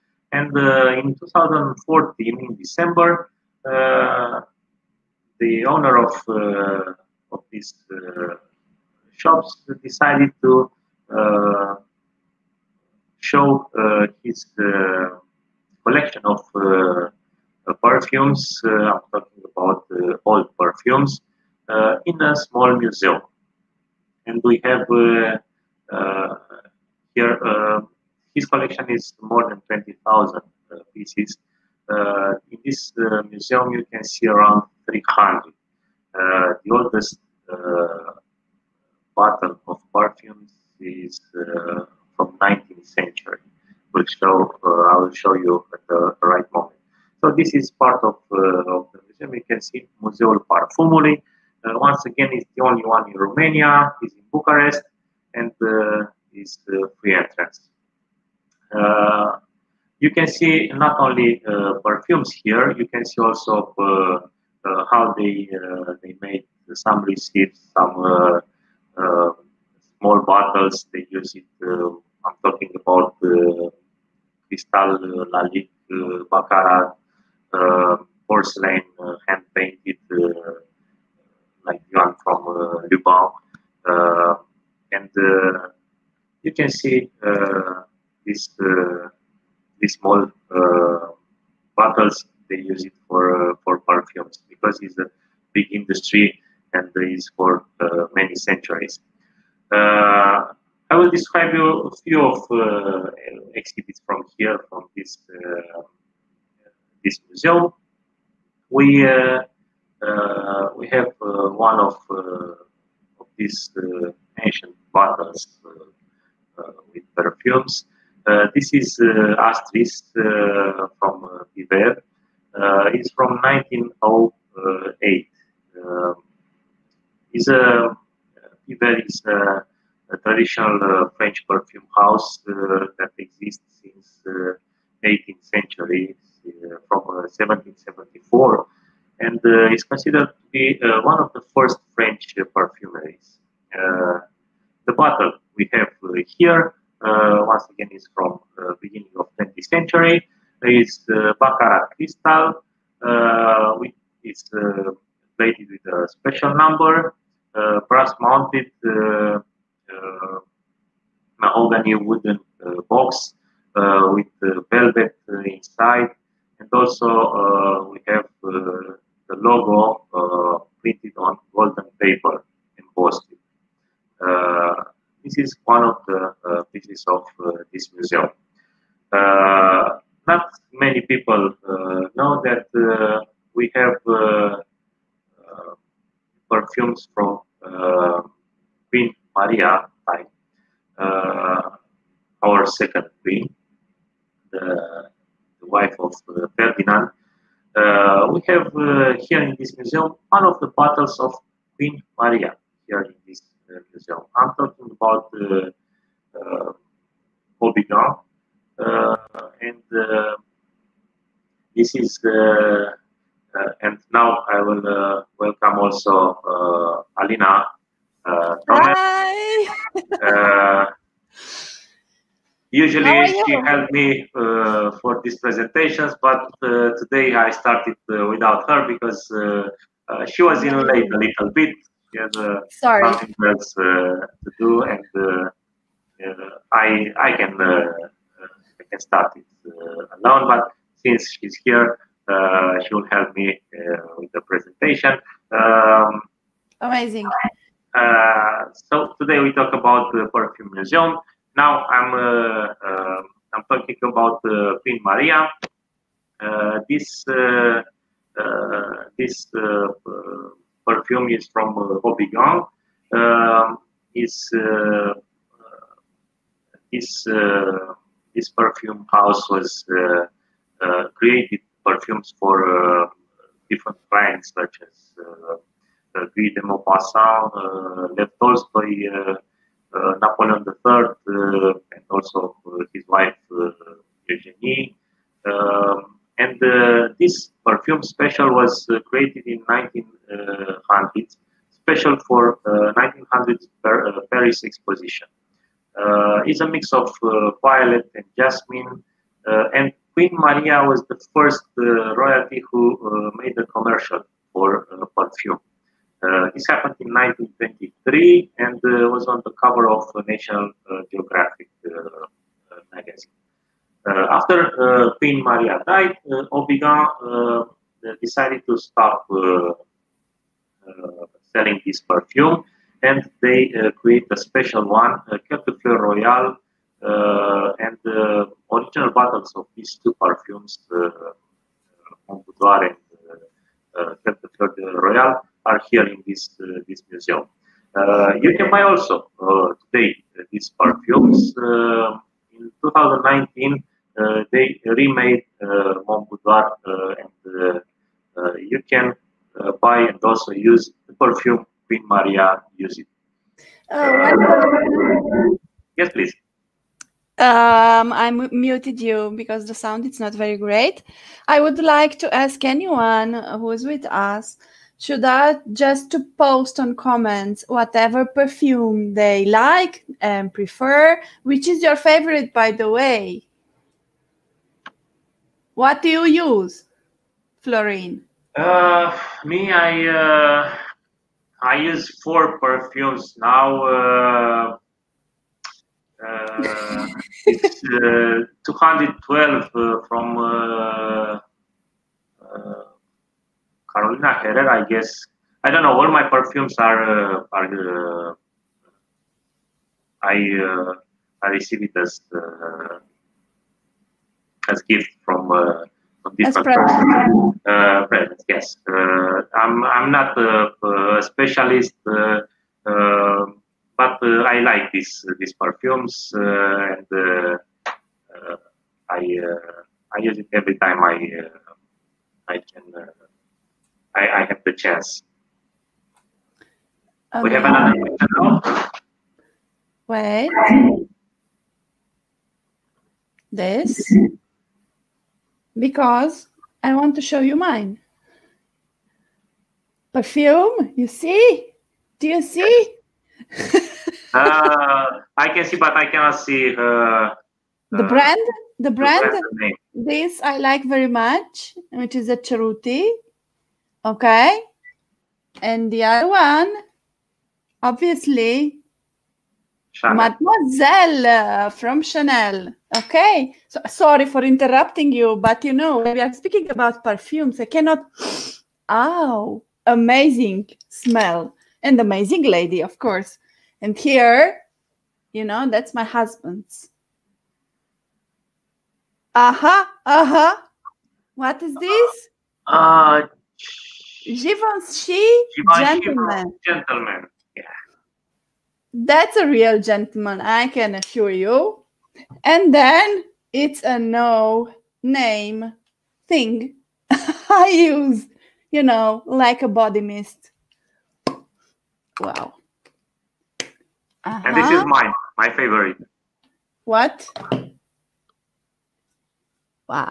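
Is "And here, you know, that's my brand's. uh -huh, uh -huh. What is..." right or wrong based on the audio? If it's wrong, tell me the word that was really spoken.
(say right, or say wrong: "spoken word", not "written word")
wrong: "husband", not "brand".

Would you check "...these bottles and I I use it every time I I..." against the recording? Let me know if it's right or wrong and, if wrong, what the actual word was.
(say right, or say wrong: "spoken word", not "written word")
wrong: "perfumes", not "bottles".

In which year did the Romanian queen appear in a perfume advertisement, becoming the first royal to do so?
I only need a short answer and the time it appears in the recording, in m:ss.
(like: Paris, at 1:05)
1923, at 5:07.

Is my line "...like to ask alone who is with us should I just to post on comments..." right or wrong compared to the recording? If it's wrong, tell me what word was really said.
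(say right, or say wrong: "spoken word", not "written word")
wrong: "anyone", not "alone".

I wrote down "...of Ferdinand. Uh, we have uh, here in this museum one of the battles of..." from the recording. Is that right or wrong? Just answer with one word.
right.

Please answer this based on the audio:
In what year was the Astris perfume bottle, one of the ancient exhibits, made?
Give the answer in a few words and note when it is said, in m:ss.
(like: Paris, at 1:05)
1908, at 2:03.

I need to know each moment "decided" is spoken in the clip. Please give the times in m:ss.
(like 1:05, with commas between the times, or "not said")
0:09, 5:18.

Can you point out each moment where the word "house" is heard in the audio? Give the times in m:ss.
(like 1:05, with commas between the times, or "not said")
2:11, 4:29.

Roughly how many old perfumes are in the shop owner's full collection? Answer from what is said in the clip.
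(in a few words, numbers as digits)
more than 20,000.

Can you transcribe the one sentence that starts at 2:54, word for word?
Uh, this is one of the uh, pieces of uh, this museum.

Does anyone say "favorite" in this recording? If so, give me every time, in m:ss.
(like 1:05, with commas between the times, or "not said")
6:11, 8:25.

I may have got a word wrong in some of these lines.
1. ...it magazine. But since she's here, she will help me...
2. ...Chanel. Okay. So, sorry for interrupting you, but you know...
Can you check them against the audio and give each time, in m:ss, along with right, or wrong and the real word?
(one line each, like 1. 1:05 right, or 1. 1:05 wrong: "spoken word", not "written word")
1. 3:59 wrong: "alone", not "magazine"
2. 7:42 right.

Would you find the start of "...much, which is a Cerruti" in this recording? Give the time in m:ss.
7:31.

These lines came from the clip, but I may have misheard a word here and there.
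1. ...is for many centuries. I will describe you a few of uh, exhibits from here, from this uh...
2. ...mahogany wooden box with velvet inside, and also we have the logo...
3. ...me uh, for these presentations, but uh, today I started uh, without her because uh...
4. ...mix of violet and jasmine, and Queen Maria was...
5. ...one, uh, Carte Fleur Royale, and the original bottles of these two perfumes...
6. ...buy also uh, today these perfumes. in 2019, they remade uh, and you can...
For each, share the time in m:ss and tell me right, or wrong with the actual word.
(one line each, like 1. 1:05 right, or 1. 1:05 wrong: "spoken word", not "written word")
1. 1:37 right
2. 2:41 right
3. 3:43 right
4. 4:56 right
5. 5:24 right
6. 5:38 right.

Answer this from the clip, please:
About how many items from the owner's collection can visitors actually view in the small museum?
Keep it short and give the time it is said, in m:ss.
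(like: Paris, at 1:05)
around 300, at 0:34.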